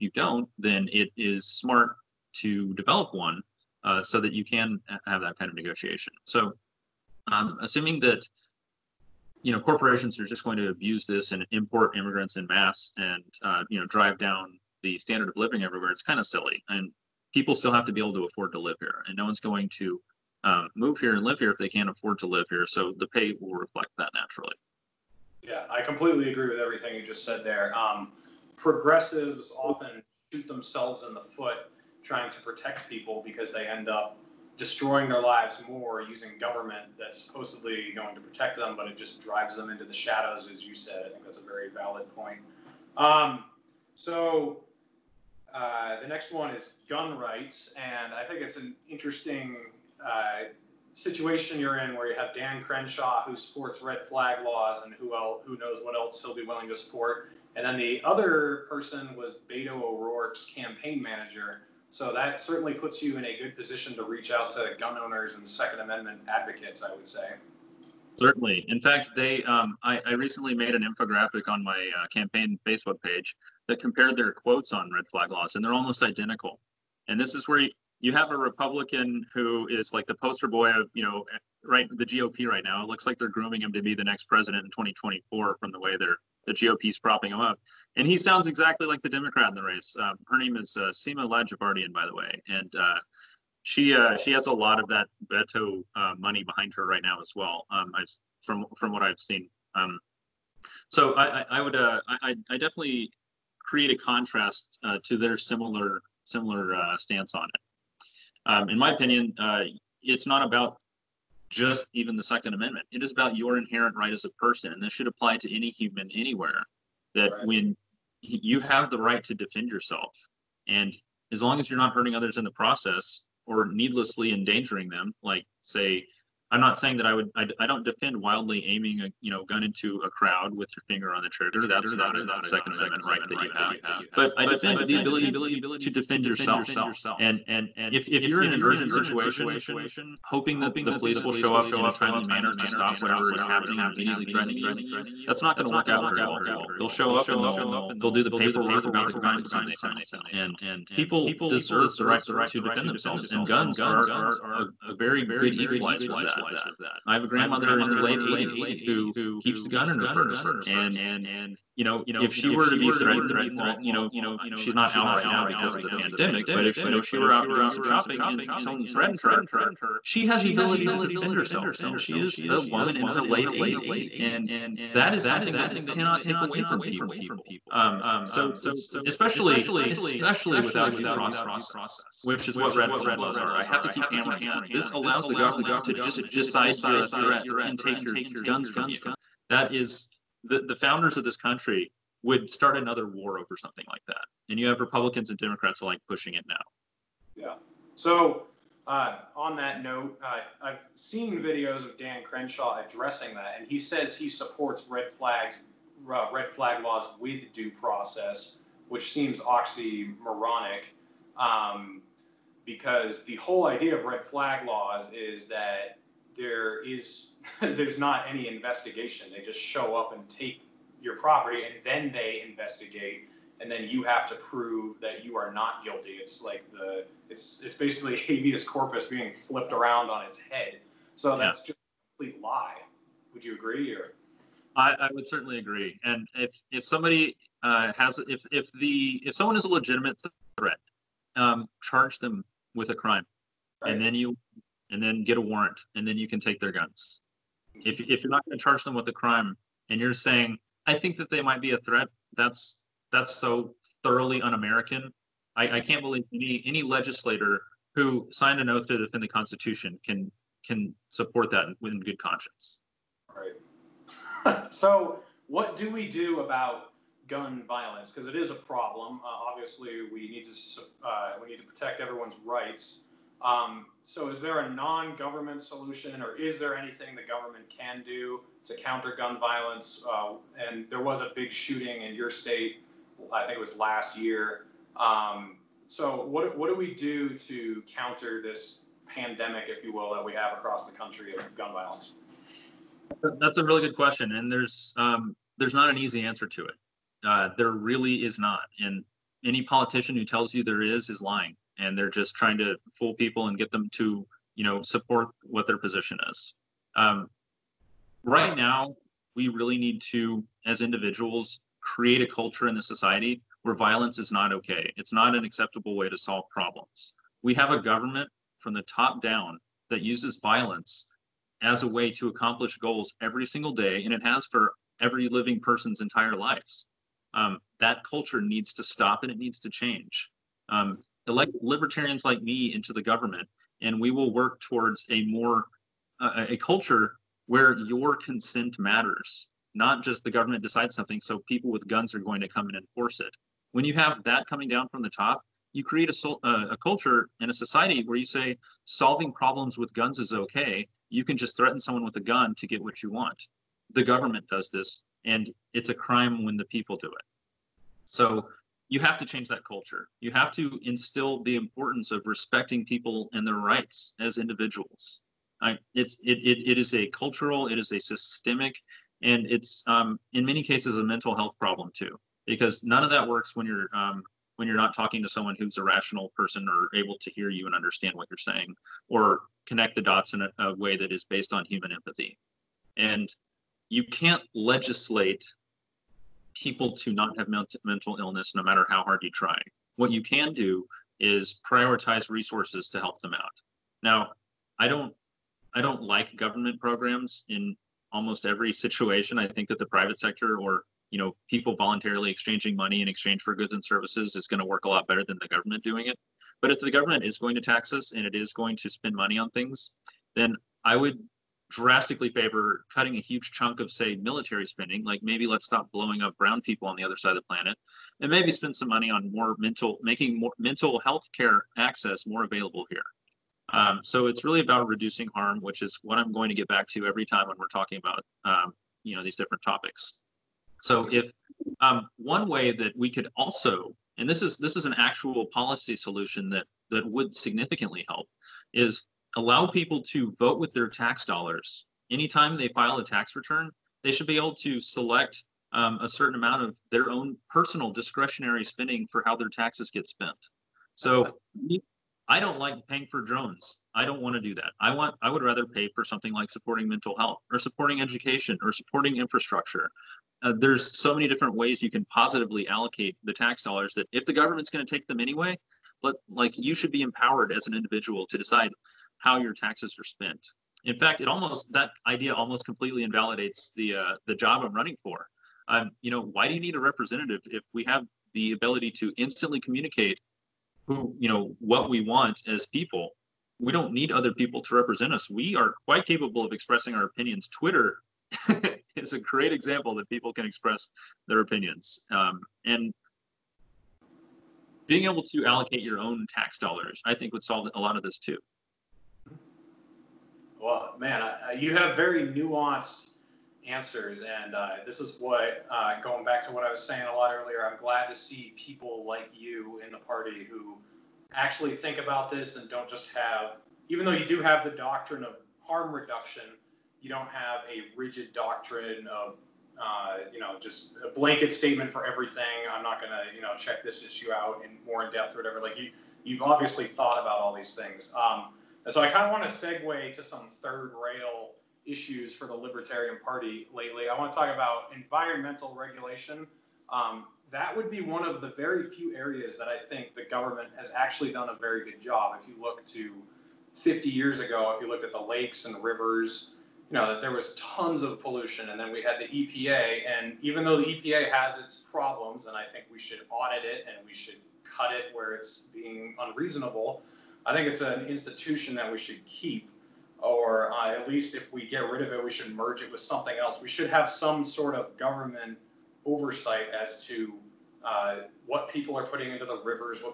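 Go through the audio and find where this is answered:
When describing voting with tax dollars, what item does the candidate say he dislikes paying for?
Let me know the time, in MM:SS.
07:33.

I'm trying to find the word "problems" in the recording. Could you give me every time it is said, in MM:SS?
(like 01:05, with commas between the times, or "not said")
04:28, 05:16, 05:49, 06:11, 09:11.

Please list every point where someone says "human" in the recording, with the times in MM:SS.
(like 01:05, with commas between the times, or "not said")
01:55, 06:21.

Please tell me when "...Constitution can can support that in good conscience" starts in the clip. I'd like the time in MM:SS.
04:19.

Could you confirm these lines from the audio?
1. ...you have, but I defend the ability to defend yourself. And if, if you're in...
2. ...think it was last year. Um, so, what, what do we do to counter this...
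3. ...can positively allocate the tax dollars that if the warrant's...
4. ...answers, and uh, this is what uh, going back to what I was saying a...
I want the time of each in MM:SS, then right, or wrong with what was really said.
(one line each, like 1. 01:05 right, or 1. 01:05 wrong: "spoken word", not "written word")
1. 02:13 right
2. 04:43 right
3. 07:41 wrong: "government", not "warrant"
4. 08:23 right.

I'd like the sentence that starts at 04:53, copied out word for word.
That's a really good question, and there's um, there's not an easy answer to it.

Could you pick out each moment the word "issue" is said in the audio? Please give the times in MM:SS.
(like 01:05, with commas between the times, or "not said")
08:44, 08:51.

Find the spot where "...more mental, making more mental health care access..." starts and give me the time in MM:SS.
06:59.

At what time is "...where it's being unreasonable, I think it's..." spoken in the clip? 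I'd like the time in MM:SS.
09:15.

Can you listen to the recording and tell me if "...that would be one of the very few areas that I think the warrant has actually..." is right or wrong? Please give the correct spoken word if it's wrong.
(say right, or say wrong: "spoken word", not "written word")
wrong: "government", not "warrant".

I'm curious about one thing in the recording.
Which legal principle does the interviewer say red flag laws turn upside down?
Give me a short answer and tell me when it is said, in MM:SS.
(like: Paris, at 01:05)
habeas corpus, at 03:48.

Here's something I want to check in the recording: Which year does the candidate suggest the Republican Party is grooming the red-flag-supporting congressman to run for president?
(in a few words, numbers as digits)
2024.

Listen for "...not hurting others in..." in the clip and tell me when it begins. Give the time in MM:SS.
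02:01.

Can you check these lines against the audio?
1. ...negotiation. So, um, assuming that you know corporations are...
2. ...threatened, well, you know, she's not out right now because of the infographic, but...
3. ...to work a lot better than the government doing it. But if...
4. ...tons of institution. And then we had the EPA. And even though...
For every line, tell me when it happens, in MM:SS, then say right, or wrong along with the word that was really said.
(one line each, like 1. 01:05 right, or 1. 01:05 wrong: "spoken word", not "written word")
1. 00:05 right
2. 02:42 wrong: "pandemic", not "infographic"
3. 06:44 right
4. 09:07 wrong: "pollution", not "institution".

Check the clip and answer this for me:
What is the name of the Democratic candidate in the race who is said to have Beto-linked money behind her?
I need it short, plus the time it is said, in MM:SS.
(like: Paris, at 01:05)
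Sima Ladjevardian, at 01:30.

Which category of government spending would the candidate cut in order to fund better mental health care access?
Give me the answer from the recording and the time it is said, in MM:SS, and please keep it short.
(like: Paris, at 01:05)
military spending, at 06:54.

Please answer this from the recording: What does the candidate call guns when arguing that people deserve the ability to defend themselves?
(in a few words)
a very good equalizer.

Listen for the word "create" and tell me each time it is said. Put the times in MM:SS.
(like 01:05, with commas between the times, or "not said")
01:43, 05:11, 05:45.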